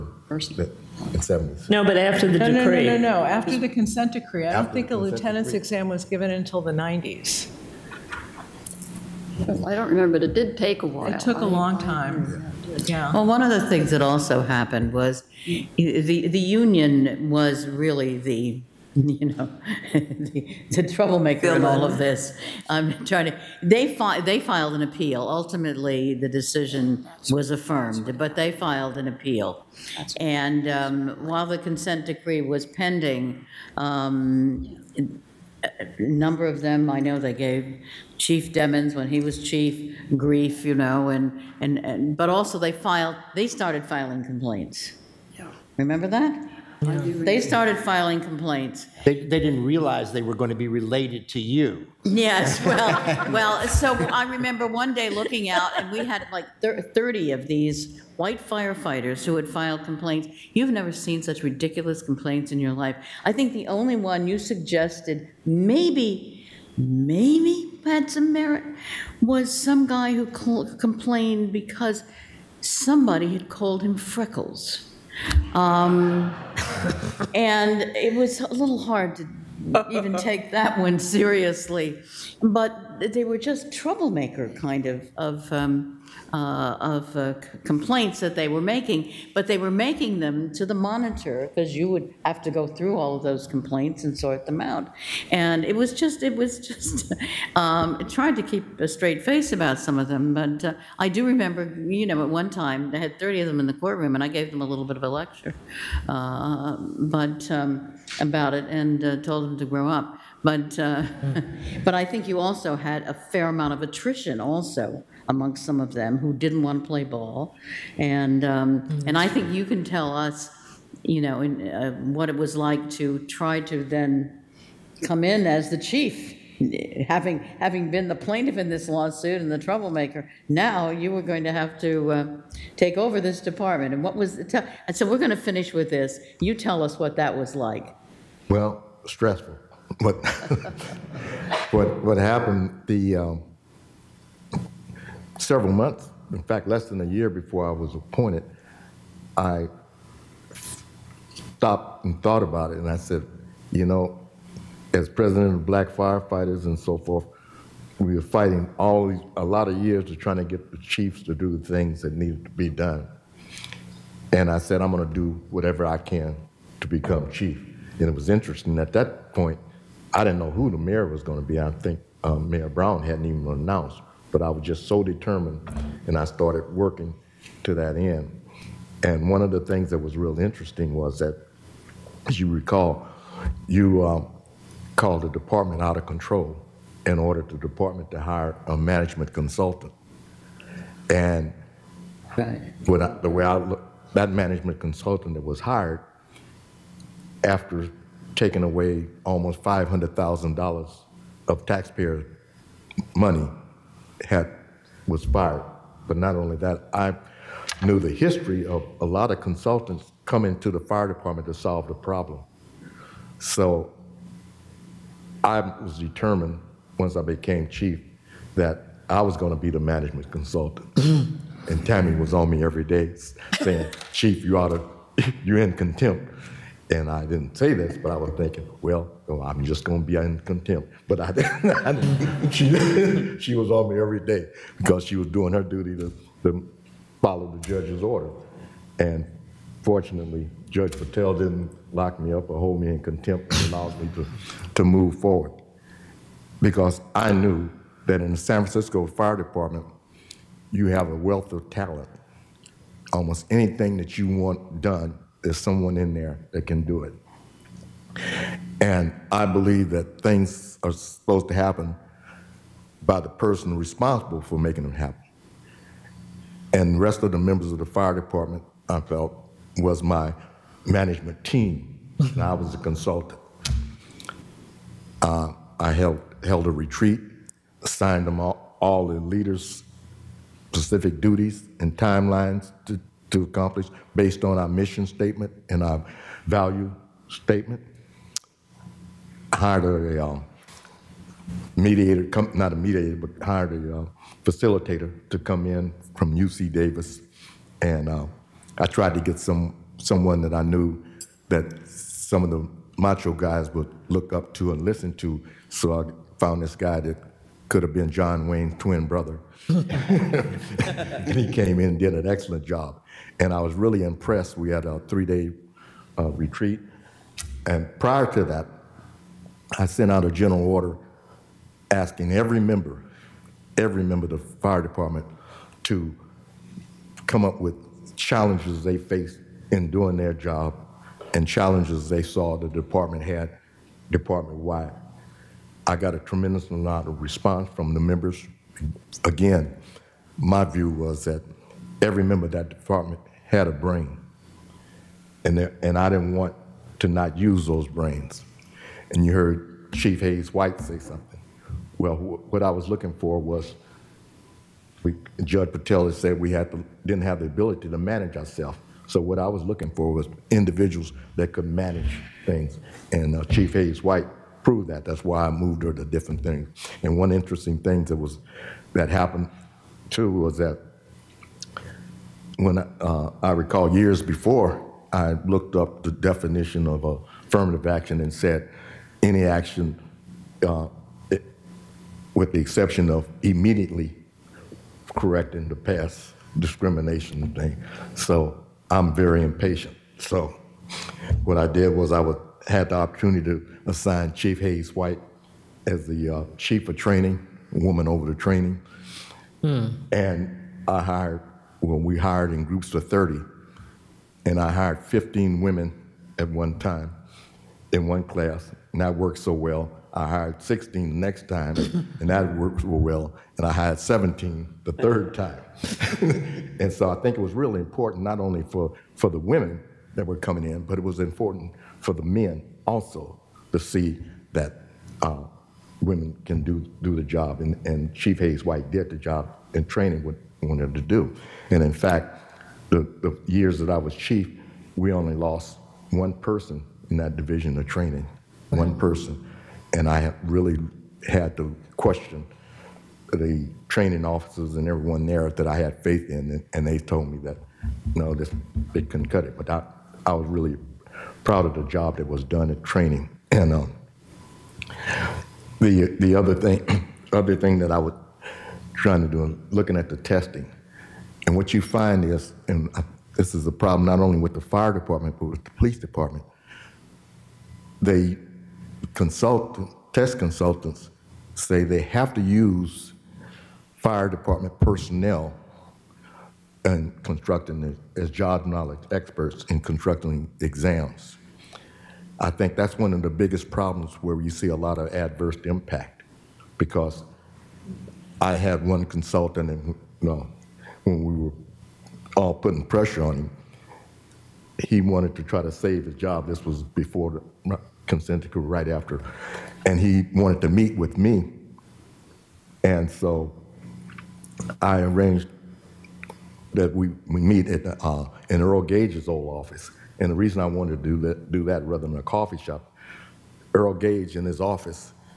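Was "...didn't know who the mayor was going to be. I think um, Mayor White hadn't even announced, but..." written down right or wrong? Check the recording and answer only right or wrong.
wrong.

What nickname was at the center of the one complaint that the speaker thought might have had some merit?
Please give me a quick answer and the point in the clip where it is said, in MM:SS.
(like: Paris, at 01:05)
Freckles, at 01:13.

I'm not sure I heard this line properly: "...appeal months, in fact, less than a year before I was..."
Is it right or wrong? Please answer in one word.
wrong.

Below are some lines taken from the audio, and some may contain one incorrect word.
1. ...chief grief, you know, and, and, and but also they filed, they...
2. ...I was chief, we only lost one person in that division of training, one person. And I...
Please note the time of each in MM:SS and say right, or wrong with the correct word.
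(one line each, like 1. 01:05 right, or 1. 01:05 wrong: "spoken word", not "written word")
1. 00:39 right
2. 07:13 right.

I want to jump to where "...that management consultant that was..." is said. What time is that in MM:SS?
03:14.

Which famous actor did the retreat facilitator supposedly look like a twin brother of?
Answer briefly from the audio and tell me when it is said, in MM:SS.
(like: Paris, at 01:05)
John Wayne, at 05:08.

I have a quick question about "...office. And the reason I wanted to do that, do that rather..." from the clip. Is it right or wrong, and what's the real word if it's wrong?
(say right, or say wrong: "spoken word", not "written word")
right.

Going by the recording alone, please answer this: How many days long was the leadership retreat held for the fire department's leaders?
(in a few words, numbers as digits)
3.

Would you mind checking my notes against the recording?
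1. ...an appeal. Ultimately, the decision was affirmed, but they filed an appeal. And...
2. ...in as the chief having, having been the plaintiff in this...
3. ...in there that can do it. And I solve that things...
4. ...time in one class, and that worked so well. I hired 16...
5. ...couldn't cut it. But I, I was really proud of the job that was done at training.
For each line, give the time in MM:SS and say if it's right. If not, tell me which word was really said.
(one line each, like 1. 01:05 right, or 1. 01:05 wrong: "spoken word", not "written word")
1. 00:24 right
2. 02:05 right
3. 04:15 wrong: "believe", not "solve"
4. 06:46 right
5. 07:29 right.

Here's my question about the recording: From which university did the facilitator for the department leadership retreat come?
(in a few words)
UC Davis.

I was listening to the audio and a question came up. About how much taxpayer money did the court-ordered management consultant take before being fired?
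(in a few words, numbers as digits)
$500,000.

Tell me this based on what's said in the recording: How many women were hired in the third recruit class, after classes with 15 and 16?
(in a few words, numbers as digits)
17.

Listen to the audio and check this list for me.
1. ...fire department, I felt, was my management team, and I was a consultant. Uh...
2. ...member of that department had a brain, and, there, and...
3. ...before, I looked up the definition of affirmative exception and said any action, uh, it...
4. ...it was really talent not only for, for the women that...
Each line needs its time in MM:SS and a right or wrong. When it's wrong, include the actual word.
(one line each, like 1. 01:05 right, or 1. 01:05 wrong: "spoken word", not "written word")
1. 04:27 right
2. 05:42 right
3. 06:14 wrong: "action", not "exception"
4. 06:57 wrong: "important", not "talent".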